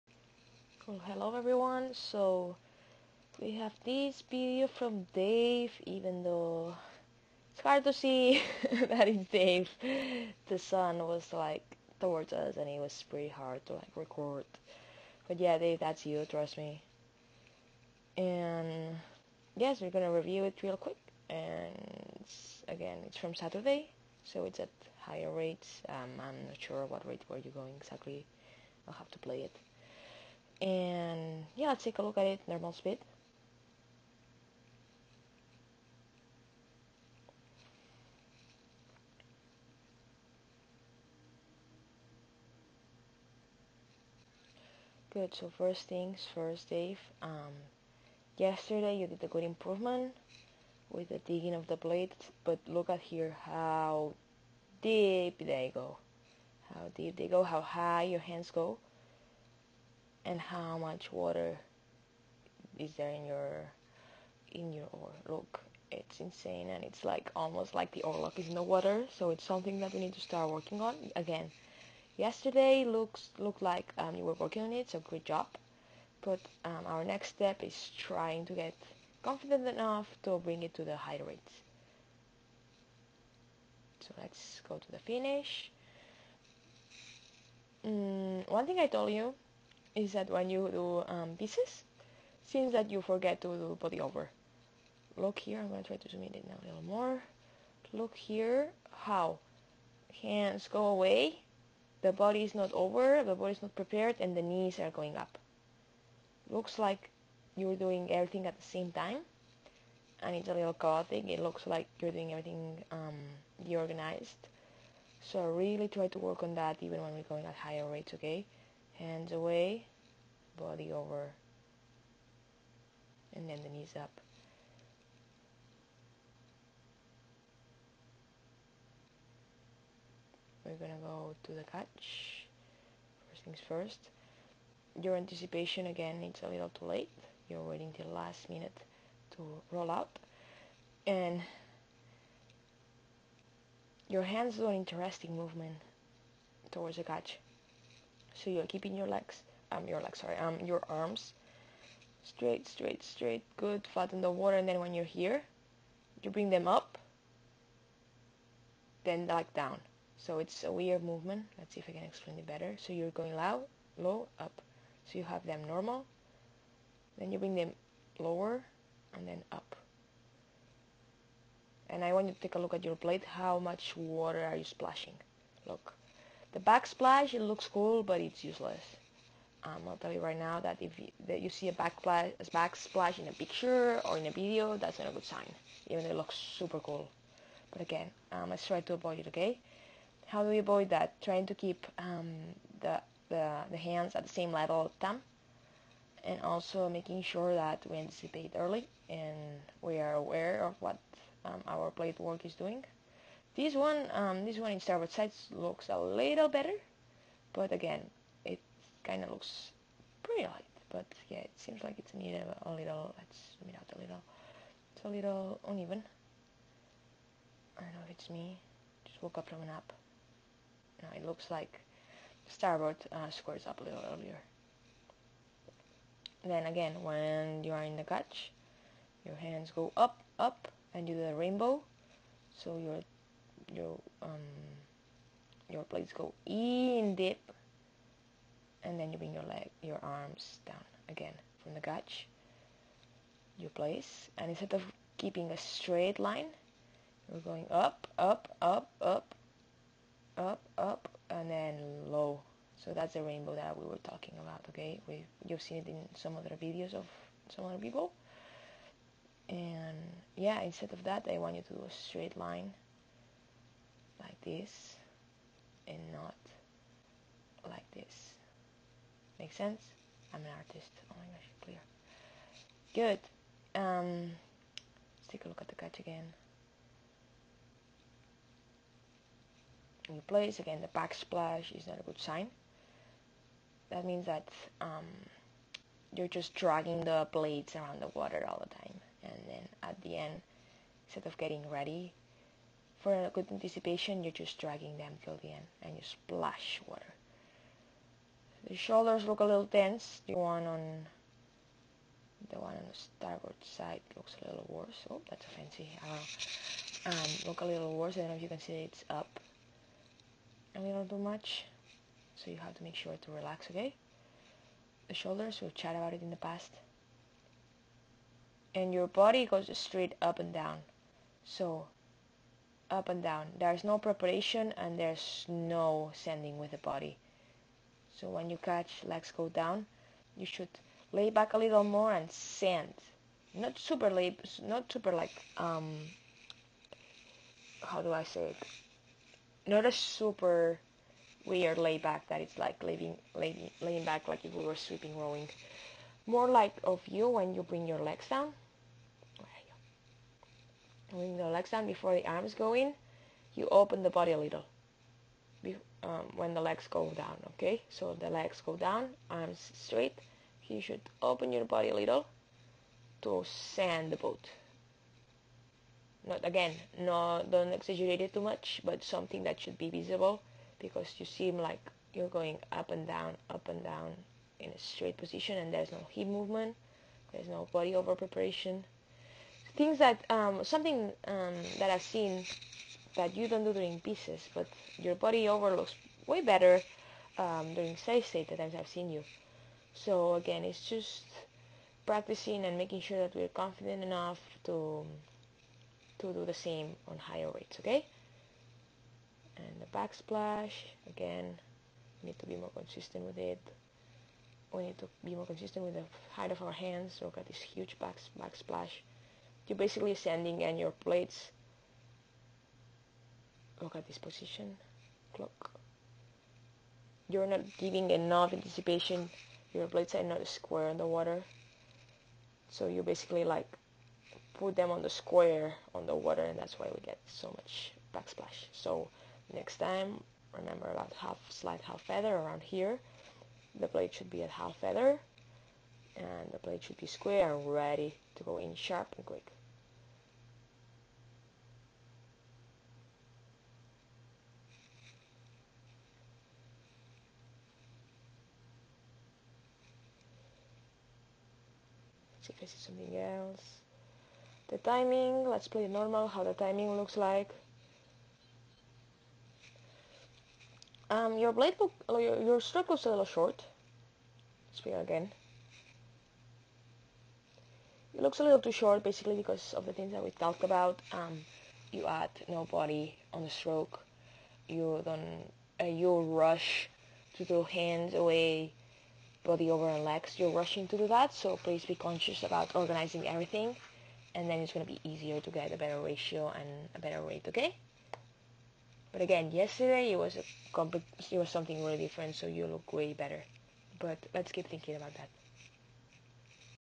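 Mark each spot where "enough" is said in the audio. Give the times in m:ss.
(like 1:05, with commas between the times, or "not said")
1:19, 6:34, 6:58.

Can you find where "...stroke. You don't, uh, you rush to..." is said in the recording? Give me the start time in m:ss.
7:53.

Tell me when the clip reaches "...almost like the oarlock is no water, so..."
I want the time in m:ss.
1:07.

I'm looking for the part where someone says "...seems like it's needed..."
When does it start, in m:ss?
3:31.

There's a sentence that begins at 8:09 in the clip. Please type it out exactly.
But again, yesterday it was a it was something really different, so you look way better.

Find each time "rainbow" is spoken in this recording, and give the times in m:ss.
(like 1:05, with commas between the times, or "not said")
3:51, 4:13.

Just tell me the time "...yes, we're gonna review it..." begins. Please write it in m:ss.
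0:19.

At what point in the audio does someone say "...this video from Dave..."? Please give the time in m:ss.
0:03.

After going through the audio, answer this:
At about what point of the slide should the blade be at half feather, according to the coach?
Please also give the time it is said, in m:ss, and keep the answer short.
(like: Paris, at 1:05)
half slide, at 7:11.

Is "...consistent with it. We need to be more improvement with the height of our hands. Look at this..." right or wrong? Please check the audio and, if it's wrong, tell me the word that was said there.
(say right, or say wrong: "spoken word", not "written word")
wrong: "consistent", not "improvement".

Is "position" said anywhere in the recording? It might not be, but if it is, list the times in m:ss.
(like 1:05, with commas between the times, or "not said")
6:15, 6:54.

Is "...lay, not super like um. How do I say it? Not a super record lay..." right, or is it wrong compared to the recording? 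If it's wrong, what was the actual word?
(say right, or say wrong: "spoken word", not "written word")
wrong: "weird", not "record".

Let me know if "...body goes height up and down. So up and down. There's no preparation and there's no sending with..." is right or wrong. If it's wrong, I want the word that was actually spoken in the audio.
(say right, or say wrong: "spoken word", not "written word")
wrong: "straight", not "height".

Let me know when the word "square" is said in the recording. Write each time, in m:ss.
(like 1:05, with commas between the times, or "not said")
3:43, 7:00, 7:05, 7:17.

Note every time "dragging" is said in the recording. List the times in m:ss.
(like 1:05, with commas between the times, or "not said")
4:46, 4:54.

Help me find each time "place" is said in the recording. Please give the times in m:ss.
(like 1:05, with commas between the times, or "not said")
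4:03, 4:40.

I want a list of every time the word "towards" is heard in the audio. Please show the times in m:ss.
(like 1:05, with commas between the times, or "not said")
0:11, 2:26.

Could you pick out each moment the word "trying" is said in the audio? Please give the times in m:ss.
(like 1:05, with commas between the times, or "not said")
1:18, 3:11.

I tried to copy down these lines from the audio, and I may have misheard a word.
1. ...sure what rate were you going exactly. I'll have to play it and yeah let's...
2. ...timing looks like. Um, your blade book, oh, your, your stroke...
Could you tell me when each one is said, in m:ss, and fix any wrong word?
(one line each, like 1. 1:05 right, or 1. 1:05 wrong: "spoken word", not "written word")
1. 0:26 right
2. 7:36 right.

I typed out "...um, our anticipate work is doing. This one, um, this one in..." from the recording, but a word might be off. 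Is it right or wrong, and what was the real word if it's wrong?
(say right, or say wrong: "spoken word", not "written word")
wrong: "plate", not "anticipate".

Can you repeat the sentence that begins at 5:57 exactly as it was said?
So the legs go down, arms straight.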